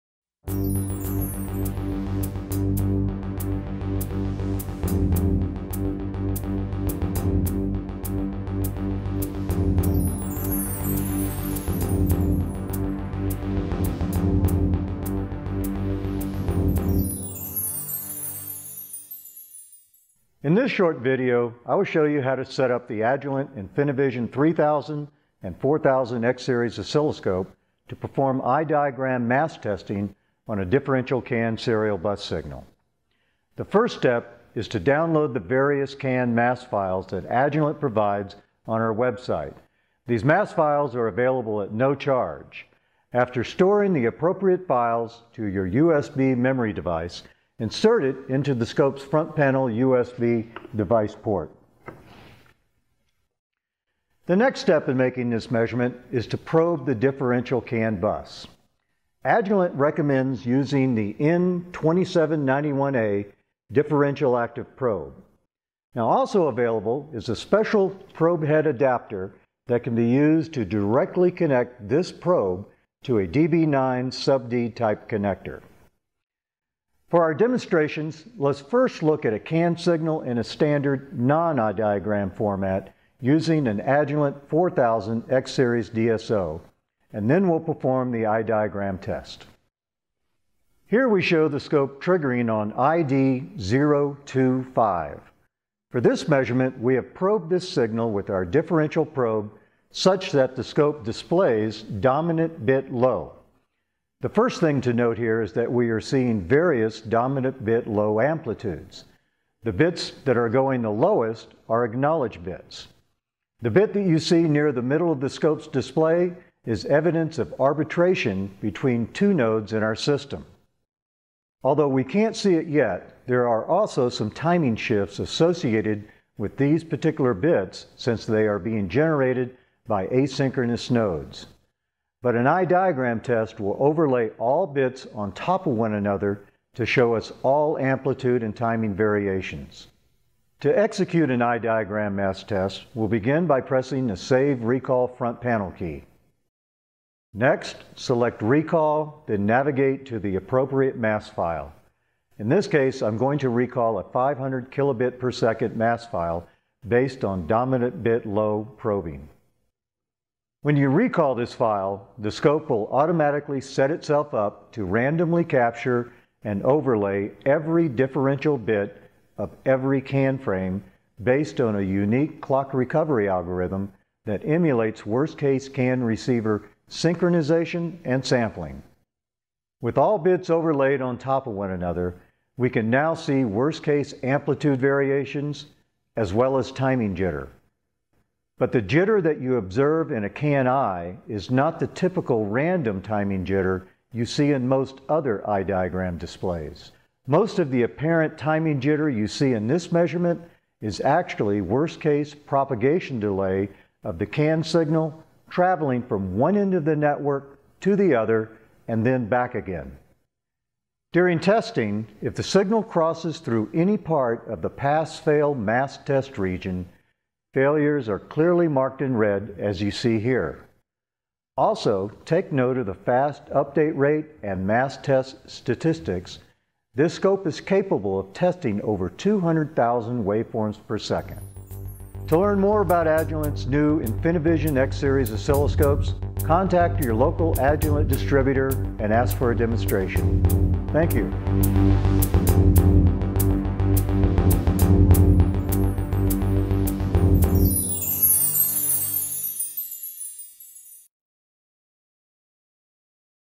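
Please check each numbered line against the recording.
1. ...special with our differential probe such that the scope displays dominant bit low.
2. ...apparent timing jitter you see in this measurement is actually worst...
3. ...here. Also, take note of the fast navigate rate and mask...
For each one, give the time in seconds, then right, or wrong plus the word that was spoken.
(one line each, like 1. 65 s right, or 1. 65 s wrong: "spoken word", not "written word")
1. 97 s wrong: "signal", not "special"
2. 197 s right
3. 220 s wrong: "update", not "navigate".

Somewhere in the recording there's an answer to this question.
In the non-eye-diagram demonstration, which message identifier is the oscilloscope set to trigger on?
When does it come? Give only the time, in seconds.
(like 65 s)
92 s.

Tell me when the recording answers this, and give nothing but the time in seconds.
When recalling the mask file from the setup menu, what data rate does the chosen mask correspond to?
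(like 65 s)
154 s.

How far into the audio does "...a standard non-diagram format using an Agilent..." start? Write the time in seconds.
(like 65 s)
80 s.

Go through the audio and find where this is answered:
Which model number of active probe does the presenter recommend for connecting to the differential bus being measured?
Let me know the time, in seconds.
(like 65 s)
61 s.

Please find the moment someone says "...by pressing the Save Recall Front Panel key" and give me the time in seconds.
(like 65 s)
143 s.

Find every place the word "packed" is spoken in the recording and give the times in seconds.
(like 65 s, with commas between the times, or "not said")
not said.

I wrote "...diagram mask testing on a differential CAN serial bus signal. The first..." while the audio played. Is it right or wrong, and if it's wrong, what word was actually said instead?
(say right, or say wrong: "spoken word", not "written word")
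right.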